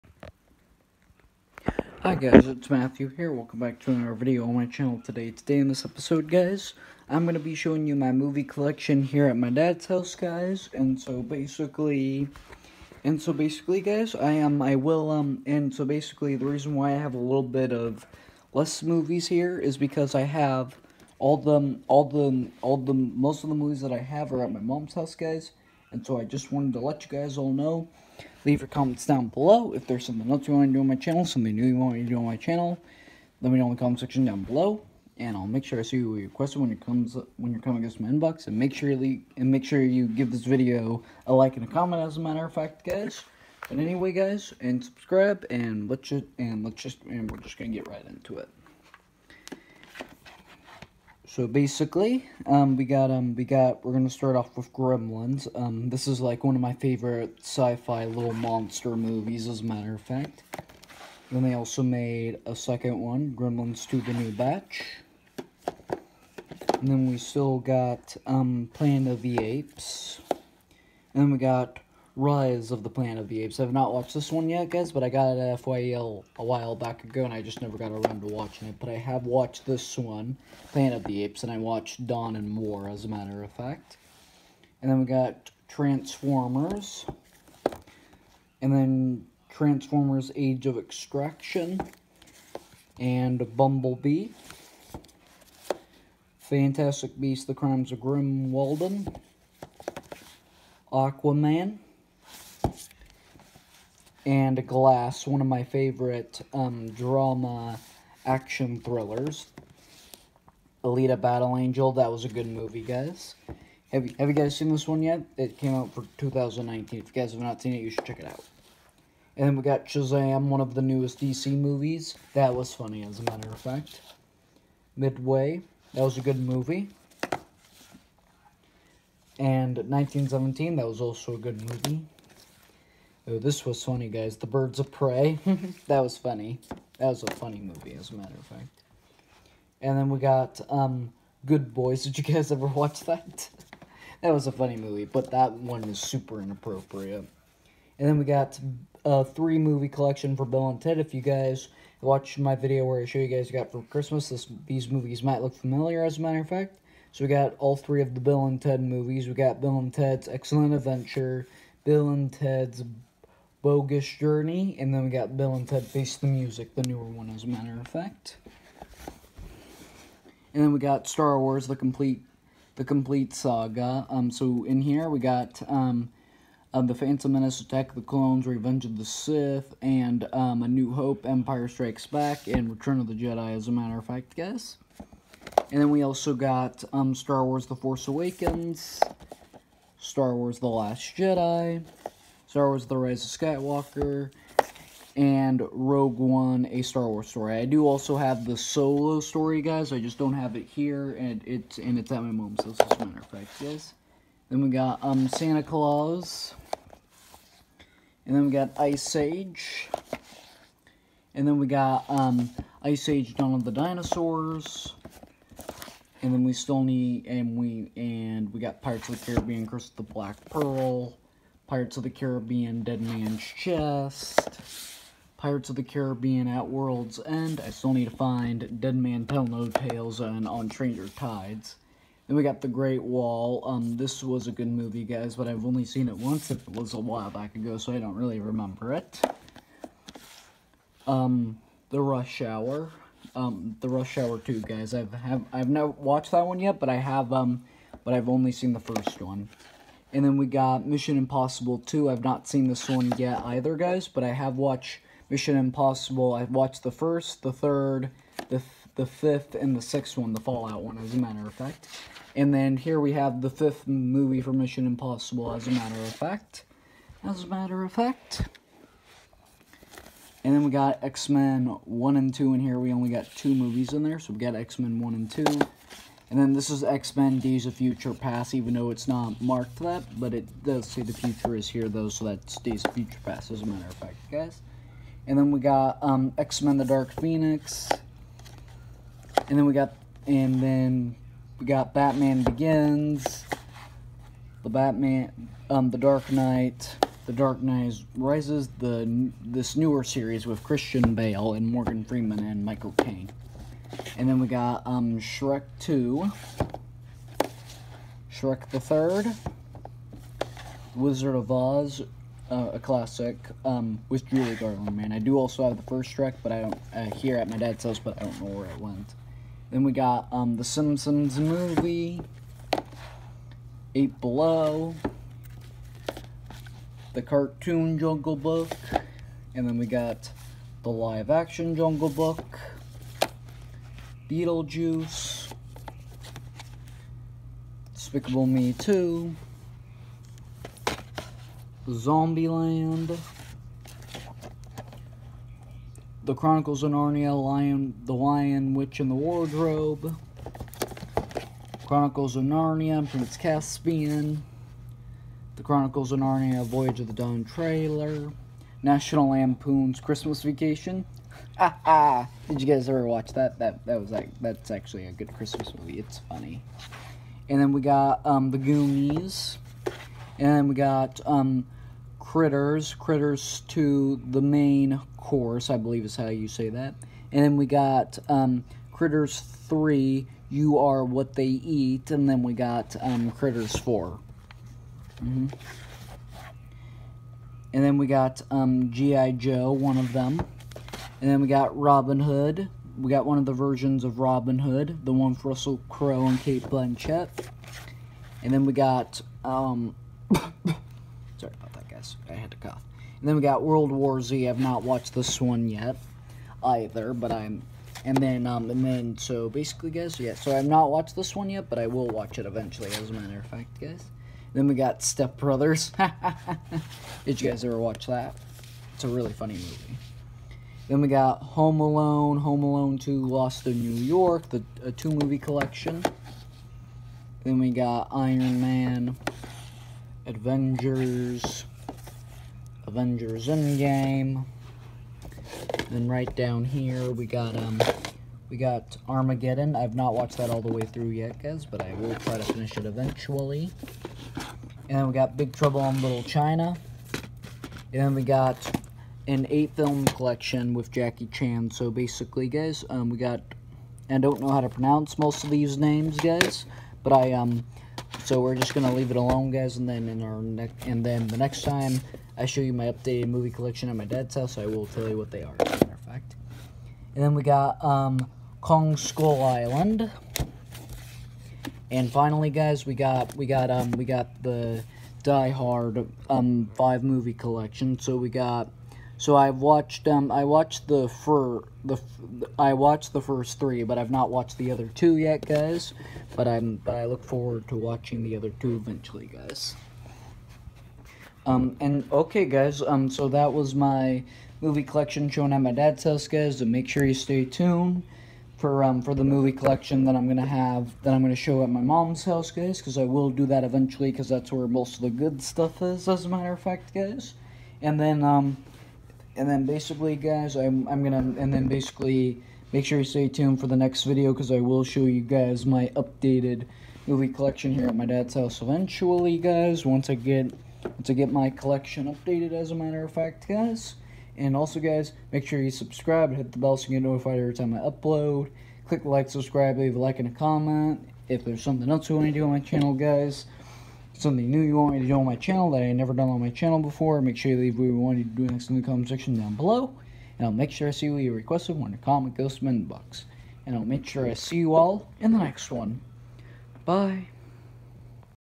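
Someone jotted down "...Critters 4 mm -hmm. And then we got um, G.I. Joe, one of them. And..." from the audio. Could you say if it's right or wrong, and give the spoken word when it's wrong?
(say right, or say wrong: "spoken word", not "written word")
right.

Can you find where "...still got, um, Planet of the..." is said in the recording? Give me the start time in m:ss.
1:07.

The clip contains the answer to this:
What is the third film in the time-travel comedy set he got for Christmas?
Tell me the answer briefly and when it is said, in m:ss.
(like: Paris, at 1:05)
Bill and Ted Face the Music, at 2:45.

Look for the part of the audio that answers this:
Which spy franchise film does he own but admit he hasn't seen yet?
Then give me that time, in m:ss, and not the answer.
4:10.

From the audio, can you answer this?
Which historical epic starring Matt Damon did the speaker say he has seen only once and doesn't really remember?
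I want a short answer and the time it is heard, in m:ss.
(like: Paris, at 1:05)
The Great Wall, at 3:52.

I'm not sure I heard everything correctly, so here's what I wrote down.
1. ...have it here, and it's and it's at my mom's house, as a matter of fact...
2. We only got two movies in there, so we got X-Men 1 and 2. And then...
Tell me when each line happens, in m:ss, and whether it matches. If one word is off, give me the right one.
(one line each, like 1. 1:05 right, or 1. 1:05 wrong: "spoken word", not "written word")
1. 3:20 right
2. 4:32 right.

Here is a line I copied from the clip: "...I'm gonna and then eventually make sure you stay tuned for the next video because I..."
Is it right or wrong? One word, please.
wrong.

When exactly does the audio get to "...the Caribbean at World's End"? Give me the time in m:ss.
3:45.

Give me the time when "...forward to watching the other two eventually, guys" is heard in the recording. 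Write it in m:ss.
8:07.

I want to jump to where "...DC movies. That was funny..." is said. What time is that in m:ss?
2:01.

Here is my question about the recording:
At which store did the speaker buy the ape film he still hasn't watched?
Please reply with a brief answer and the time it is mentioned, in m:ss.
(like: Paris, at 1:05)
FYE, at 1:15.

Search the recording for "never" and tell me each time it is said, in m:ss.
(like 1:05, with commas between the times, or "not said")
1:17, 8:55.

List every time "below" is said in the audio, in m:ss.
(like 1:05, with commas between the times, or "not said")
0:29, 0:34, 5:24, 8:59.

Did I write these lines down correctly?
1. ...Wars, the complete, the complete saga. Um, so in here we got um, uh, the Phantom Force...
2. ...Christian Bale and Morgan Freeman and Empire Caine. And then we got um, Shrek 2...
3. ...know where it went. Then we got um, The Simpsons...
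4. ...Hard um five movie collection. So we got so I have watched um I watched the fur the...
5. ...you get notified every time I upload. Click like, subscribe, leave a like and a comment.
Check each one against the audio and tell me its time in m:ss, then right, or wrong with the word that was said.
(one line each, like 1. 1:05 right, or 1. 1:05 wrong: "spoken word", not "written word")
1. 2:51 wrong: "Menace", not "Force"
2. 5:00 wrong: "Michael", not "Empire"
3. 5:18 right
4. 7:55 right
5. 8:46 right.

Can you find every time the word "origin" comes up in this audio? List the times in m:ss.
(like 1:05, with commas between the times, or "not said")
not said.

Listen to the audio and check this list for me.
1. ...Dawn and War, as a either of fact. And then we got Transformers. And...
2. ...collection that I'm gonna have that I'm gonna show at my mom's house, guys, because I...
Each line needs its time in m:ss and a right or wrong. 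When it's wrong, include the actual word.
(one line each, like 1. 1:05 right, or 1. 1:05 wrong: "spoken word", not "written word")
1. 1:22 wrong: "matter", not "either"
2. 8:19 right.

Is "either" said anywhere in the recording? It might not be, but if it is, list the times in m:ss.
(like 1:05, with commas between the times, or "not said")
4:13, 6:46.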